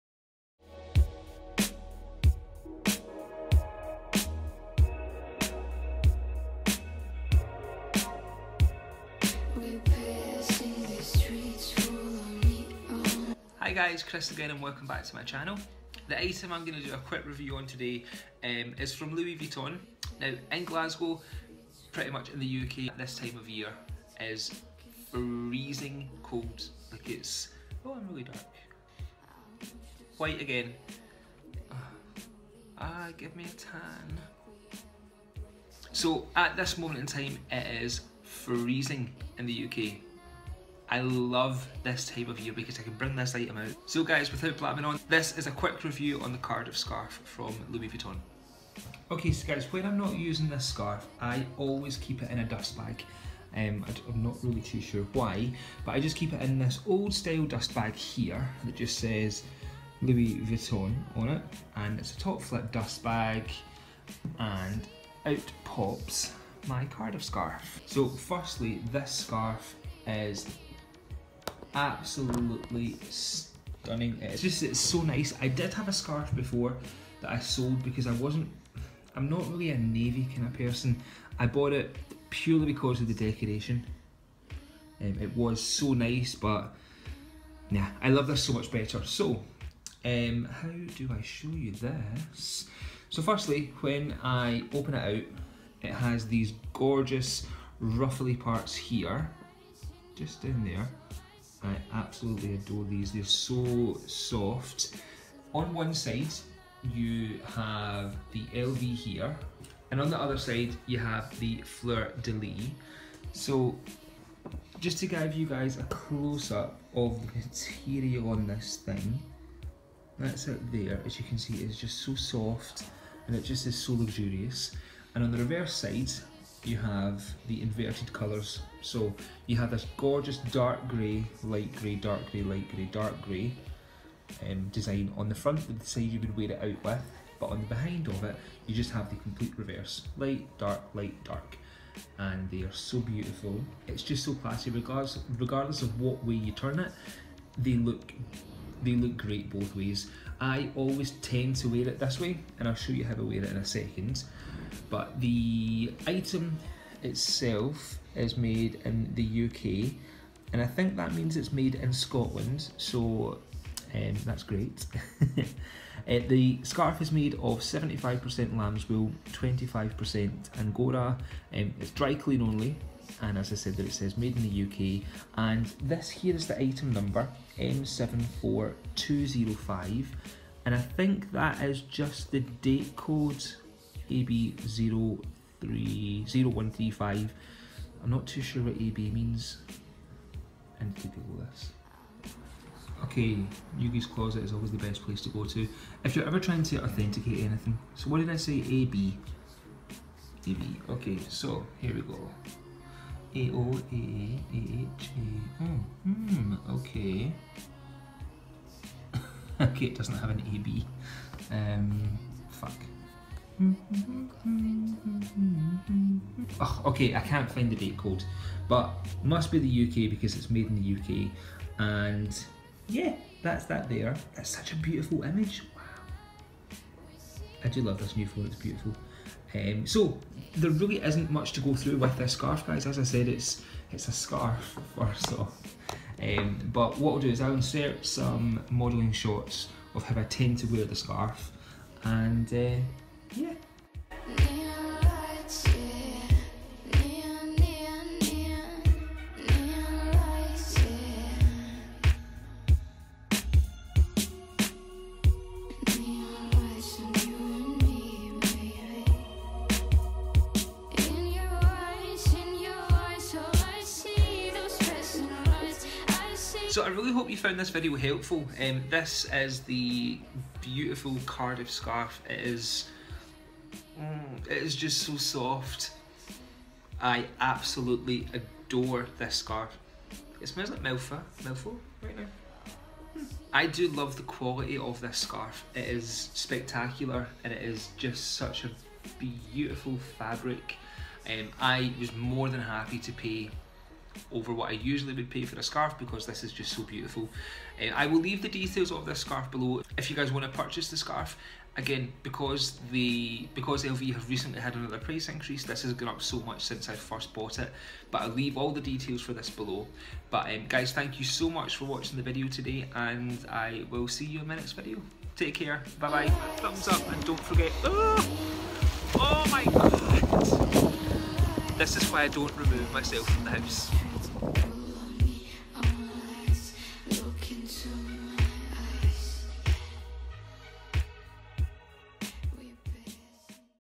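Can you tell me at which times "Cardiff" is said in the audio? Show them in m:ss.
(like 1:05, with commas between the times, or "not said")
0:46, 1:06.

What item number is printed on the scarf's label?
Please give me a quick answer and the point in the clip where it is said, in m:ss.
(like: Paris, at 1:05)
M74205, at 2:57.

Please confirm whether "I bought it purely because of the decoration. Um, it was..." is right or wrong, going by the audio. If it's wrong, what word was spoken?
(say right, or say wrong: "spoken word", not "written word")
right.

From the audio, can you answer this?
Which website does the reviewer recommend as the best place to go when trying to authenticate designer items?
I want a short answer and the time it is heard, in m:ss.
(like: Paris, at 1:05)
Yoogi's Closet, at 3:13.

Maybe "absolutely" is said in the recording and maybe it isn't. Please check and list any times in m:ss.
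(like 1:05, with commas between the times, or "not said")
1:11, 1:41, 4:37.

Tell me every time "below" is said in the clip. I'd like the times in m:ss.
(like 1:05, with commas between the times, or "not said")
4:59, 5:09.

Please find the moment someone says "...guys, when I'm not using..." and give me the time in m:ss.
0:49.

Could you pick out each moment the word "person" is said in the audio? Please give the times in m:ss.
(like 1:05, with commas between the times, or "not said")
1:20.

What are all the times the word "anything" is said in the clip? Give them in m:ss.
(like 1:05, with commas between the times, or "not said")
3:17.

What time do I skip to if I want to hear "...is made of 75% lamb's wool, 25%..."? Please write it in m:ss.
2:47.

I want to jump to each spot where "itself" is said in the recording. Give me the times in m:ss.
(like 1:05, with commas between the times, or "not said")
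2:37.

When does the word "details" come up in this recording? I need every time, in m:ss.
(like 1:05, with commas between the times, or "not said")
4:58, 5:08.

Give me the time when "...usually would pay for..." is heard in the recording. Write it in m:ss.
4:54.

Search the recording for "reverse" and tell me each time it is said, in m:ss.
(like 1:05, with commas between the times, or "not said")
2:05, 2:19.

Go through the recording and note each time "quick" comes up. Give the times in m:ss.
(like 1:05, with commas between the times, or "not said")
0:16, 0:45.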